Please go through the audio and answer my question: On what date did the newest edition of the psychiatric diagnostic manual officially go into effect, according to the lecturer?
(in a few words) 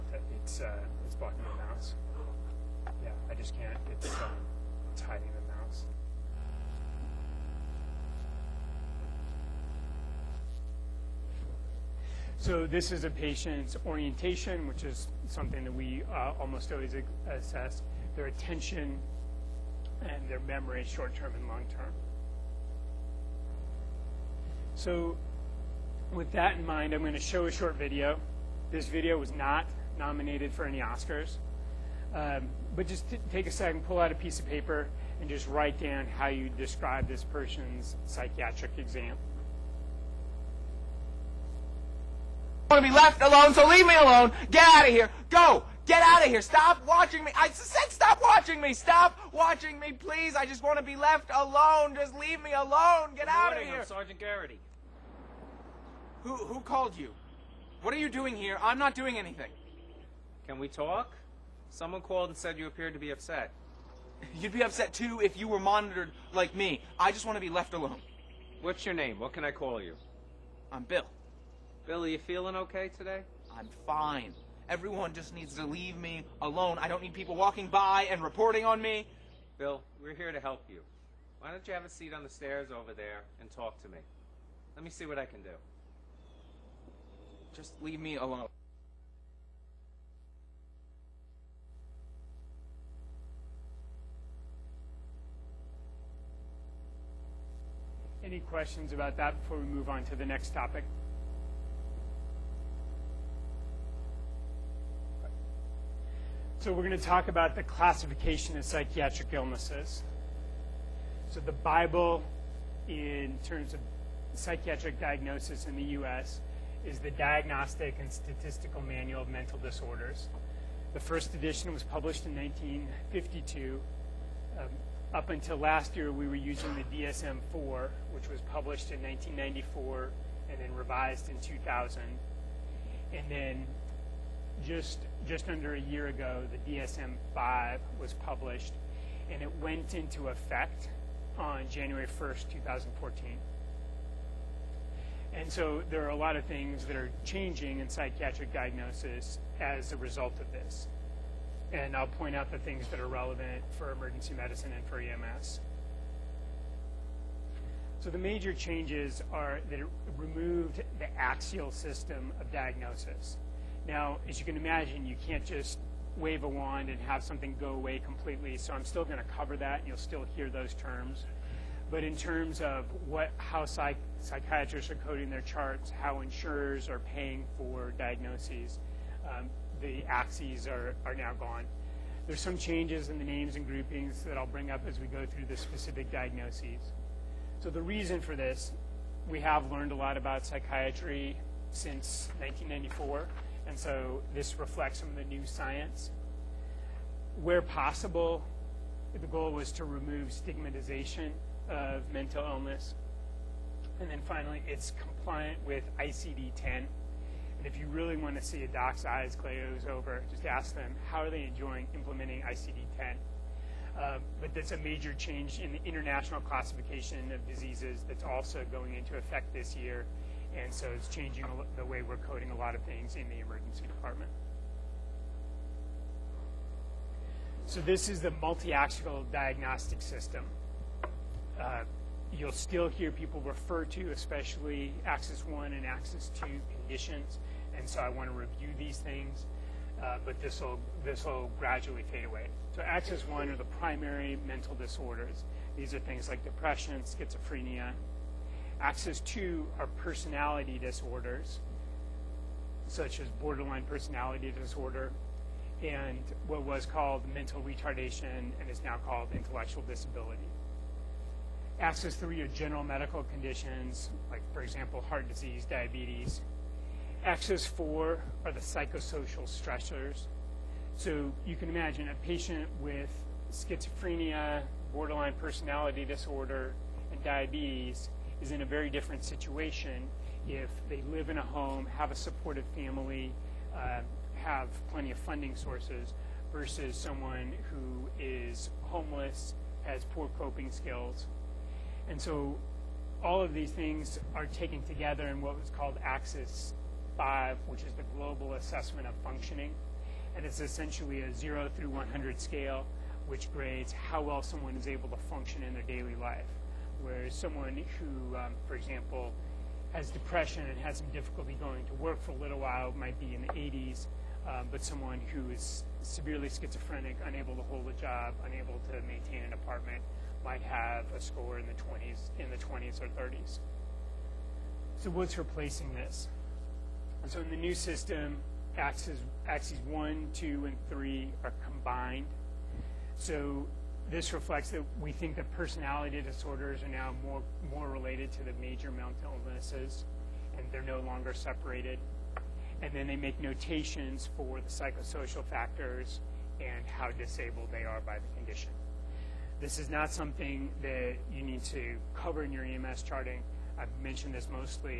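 January 1st, 2014.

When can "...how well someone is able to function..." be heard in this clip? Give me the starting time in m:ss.
5:03.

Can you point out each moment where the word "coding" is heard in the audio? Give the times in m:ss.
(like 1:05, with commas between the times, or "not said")
2:54, 3:42.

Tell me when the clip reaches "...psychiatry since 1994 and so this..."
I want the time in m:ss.
3:10.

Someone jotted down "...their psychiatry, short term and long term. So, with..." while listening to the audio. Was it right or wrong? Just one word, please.
wrong.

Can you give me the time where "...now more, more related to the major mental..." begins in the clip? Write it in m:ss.
5:36.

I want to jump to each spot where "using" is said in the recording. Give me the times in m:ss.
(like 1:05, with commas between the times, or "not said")
2:06.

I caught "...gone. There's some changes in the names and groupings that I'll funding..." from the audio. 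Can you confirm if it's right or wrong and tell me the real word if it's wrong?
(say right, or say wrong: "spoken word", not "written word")
wrong: "bring", not "funding".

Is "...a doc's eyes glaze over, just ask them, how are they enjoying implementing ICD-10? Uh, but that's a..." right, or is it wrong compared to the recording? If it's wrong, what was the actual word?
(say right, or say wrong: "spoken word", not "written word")
right.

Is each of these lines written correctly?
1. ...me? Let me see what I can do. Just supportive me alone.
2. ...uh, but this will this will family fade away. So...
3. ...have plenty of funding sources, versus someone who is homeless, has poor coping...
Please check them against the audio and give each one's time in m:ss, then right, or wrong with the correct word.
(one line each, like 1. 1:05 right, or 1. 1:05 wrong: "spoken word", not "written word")
1. 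1:23 wrong: "leave", not "supportive"
2. 4:00 wrong: "gradually", not "family"
3. 4:44 right.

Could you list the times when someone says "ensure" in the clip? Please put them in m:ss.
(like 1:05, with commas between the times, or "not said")
not said.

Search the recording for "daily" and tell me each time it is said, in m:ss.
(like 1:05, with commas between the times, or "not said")
5:05.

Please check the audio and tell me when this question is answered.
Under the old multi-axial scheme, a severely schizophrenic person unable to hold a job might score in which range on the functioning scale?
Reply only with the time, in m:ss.
5:22.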